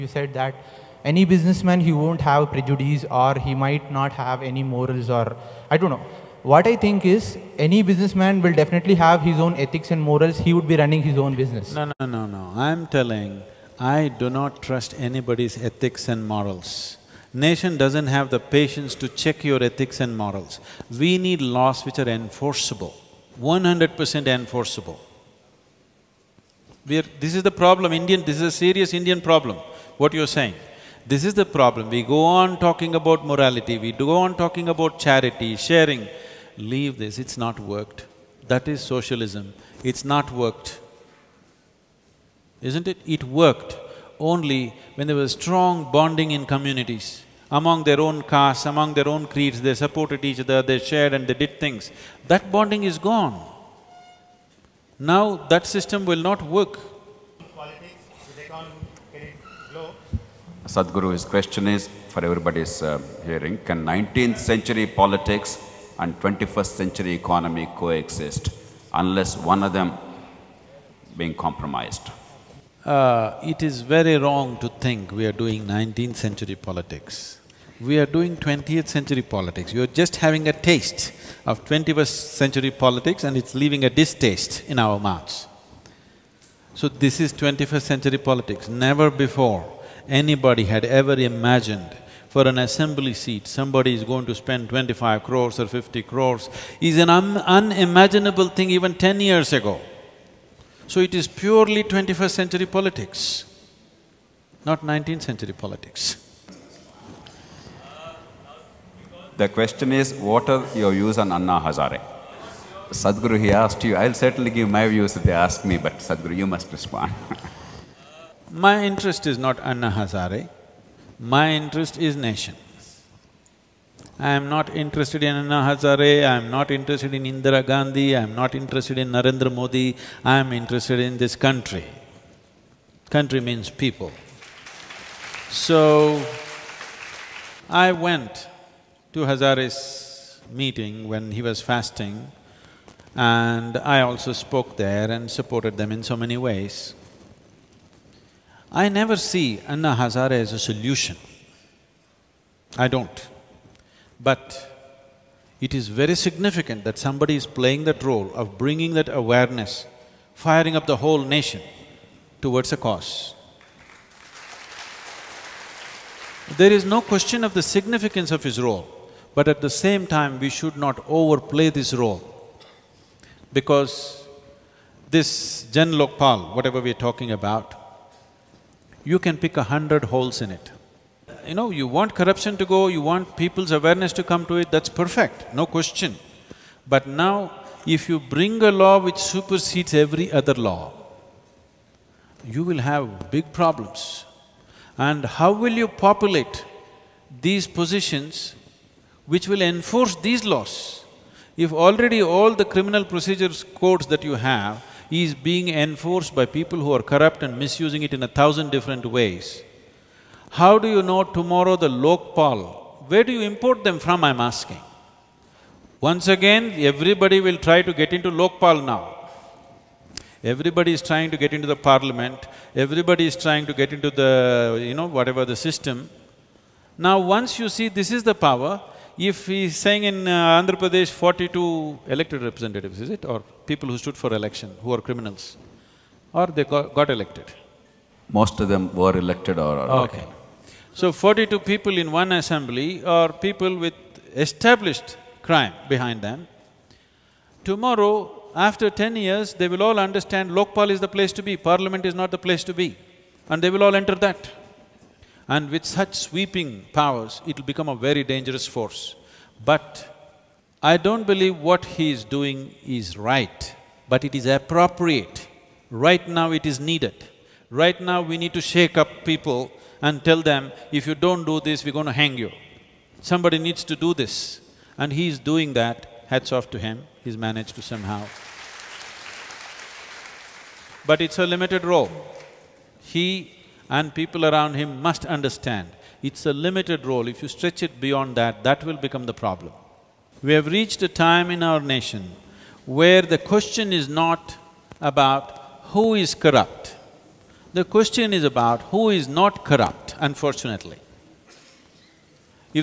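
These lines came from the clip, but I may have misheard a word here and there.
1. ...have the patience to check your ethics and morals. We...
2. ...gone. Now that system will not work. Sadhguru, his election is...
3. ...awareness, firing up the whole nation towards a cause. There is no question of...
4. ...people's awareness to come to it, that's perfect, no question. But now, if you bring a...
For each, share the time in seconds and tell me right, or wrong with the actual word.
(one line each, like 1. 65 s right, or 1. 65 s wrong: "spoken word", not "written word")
1. 18 s right
2. 52 s wrong: "question", not "election"
3. 159 s right
4. 183 s right.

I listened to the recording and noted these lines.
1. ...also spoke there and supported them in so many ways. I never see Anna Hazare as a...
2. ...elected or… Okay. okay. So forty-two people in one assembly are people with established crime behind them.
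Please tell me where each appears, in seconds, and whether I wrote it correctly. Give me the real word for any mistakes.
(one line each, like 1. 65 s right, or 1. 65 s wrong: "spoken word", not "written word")
1. 144 s right
2. 239 s right.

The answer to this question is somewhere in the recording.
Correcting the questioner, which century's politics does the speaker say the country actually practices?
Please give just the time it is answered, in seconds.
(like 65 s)
78 s.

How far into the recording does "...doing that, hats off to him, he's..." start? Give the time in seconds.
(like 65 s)
275 s.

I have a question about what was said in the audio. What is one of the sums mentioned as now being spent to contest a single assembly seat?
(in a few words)
25 crores.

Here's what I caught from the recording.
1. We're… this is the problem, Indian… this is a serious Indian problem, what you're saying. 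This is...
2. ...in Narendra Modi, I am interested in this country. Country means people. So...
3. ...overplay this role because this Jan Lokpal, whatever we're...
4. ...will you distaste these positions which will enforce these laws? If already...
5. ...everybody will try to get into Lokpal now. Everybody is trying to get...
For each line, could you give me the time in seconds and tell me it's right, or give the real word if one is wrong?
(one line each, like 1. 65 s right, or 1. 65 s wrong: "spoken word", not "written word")
1. 26 s right
2. 128 s right
3. 171 s right
4. 195 s wrong: "populate", not "distaste"
5. 216 s right.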